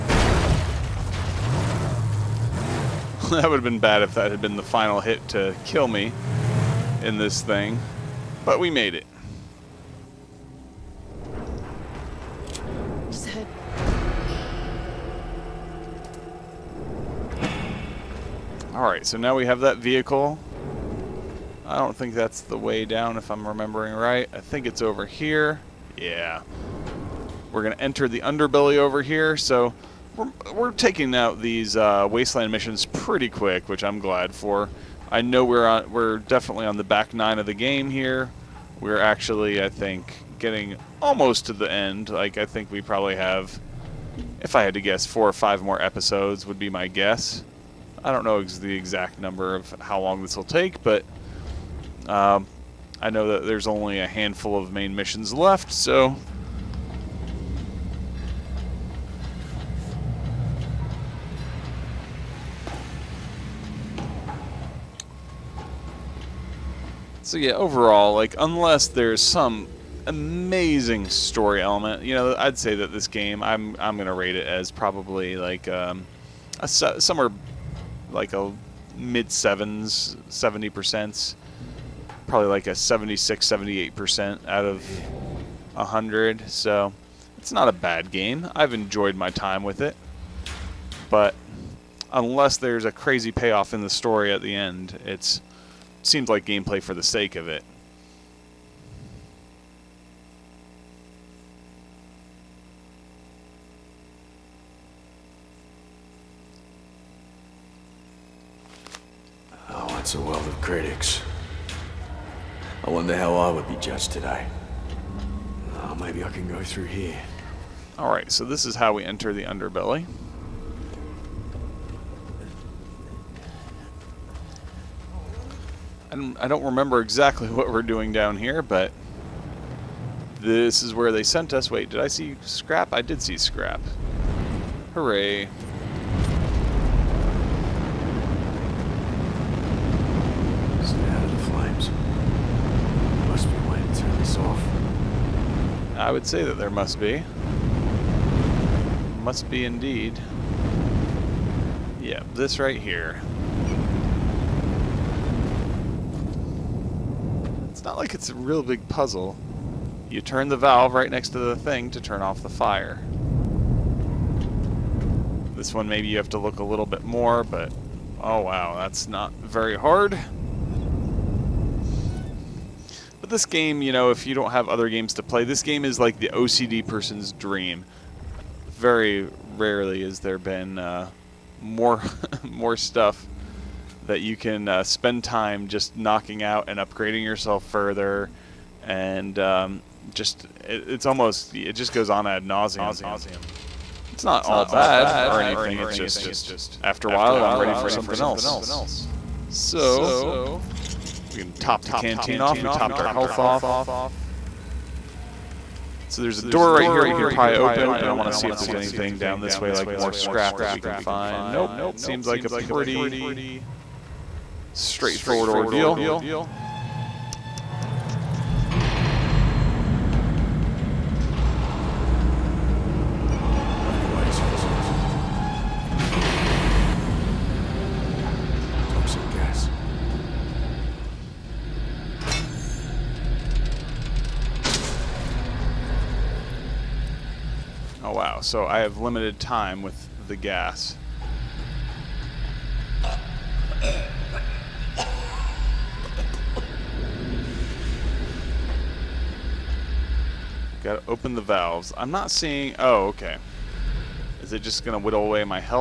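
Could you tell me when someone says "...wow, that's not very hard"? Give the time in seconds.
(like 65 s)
168 s.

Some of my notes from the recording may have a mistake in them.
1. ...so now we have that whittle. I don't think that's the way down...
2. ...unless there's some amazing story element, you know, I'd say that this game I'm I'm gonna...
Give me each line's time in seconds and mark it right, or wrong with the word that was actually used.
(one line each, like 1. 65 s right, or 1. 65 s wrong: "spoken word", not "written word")
1. 19 s wrong: "vehicle", not "whittle"
2. 68 s right.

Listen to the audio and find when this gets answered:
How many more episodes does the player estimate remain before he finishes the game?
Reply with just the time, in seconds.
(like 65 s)
45 s.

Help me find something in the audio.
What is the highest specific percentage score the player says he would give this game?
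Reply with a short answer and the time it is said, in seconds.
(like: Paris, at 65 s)
78, at 83 s.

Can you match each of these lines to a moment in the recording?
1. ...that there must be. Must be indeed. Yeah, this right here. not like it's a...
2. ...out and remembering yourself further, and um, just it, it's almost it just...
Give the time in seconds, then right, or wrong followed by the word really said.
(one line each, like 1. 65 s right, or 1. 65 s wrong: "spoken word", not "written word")
1. 146 s right
2. 186 s wrong: "upgrading", not "remembering".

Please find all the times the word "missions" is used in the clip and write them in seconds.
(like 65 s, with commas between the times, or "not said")
32 s, 54 s.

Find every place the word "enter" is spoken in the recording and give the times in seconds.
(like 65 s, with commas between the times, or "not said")
27 s, 119 s.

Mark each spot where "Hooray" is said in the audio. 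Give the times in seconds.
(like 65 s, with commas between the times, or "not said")
134 s.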